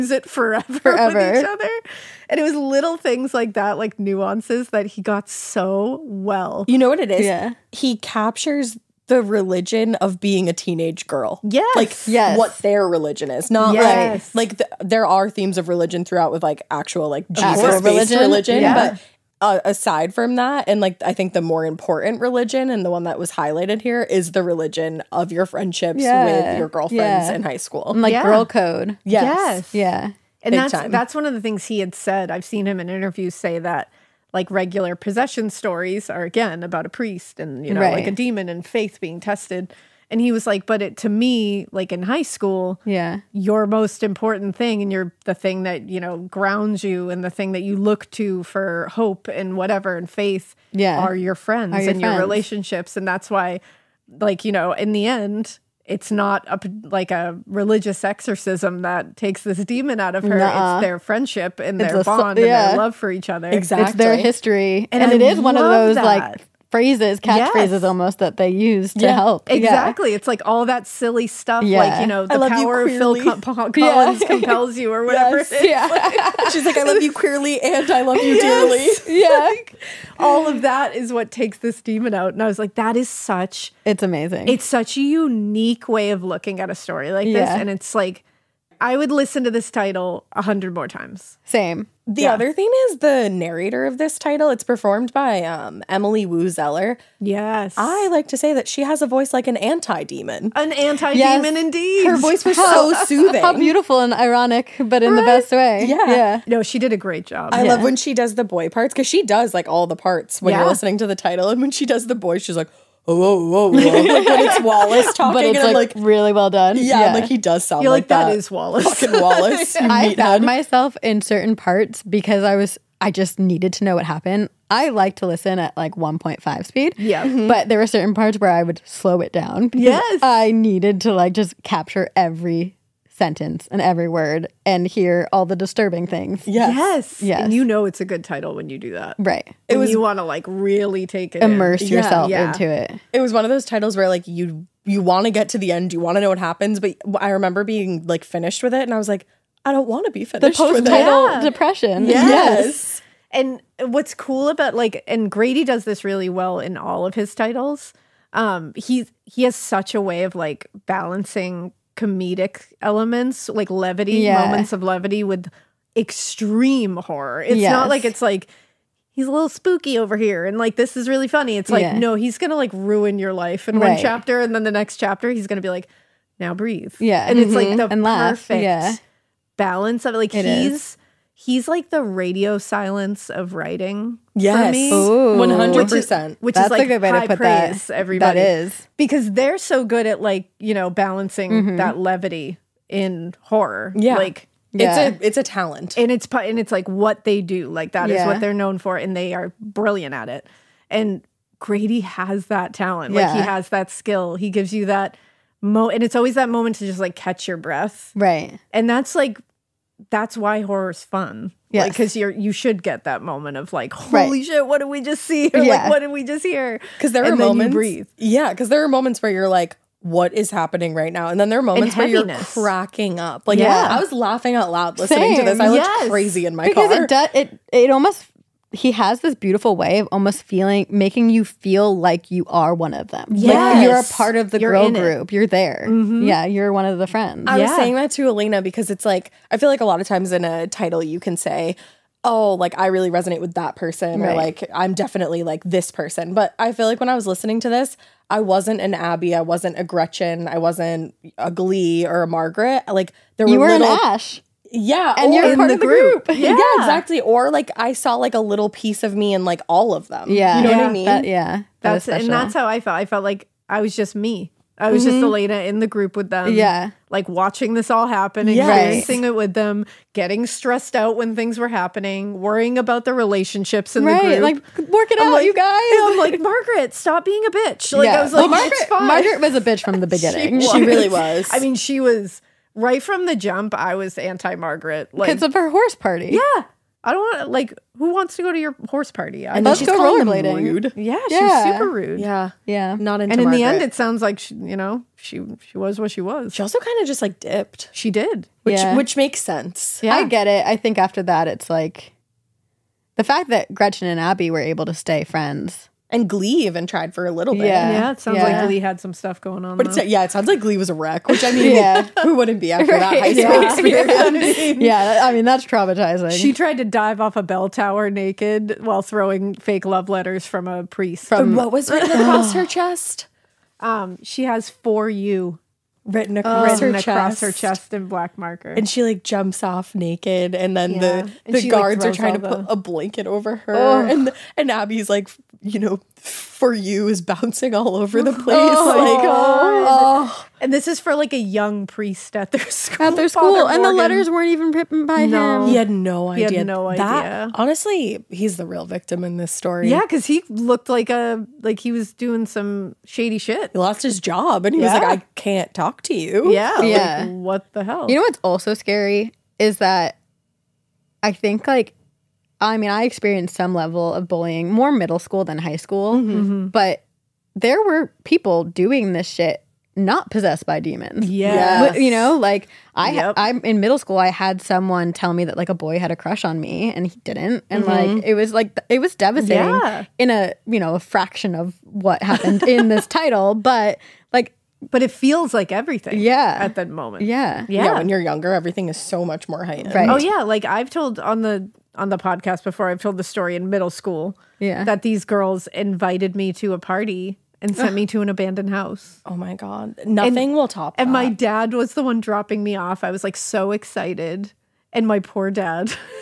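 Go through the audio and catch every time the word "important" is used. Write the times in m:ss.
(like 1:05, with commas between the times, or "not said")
0:21, 0:44.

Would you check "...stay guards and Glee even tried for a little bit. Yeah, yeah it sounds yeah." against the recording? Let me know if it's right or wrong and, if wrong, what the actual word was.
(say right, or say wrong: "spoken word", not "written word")
wrong: "friends", not "guards".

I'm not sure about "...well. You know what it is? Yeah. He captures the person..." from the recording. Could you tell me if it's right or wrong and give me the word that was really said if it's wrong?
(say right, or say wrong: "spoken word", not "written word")
wrong: "religion", not "person".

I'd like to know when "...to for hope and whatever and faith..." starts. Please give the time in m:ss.
0:48.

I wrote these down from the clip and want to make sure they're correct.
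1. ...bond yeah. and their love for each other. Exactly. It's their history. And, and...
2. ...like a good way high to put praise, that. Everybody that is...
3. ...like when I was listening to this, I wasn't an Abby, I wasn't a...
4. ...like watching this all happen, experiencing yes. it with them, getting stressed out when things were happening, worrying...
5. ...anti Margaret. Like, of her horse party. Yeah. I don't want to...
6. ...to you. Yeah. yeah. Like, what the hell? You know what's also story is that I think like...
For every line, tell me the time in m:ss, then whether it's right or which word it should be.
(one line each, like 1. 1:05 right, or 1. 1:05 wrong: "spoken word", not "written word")
1. 1:02 right
2. 3:06 right
3. 4:06 right
4. 4:27 right
5. 4:44 right
6. 5:56 wrong: "scary", not "story".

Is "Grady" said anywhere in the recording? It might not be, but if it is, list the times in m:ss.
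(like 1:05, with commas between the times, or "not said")
2:35, 3:21.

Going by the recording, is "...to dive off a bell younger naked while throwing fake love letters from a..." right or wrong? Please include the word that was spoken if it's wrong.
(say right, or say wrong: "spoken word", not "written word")
wrong: "tower", not "younger".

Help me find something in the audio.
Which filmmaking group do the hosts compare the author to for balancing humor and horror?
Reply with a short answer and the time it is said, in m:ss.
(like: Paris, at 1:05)
Radio Silence, at 3:02.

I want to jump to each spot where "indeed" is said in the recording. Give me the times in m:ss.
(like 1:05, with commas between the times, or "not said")
1:41.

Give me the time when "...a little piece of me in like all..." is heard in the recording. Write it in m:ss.
4:18.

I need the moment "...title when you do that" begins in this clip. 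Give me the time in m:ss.
2:18.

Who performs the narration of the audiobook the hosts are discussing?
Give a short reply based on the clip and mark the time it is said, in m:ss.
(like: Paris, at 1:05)
Emily Woo Zeller, at 1:35.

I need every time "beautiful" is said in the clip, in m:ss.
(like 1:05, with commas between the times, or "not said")
1:43, 3:49.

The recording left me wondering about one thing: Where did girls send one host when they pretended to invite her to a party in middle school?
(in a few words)
an abandoned house.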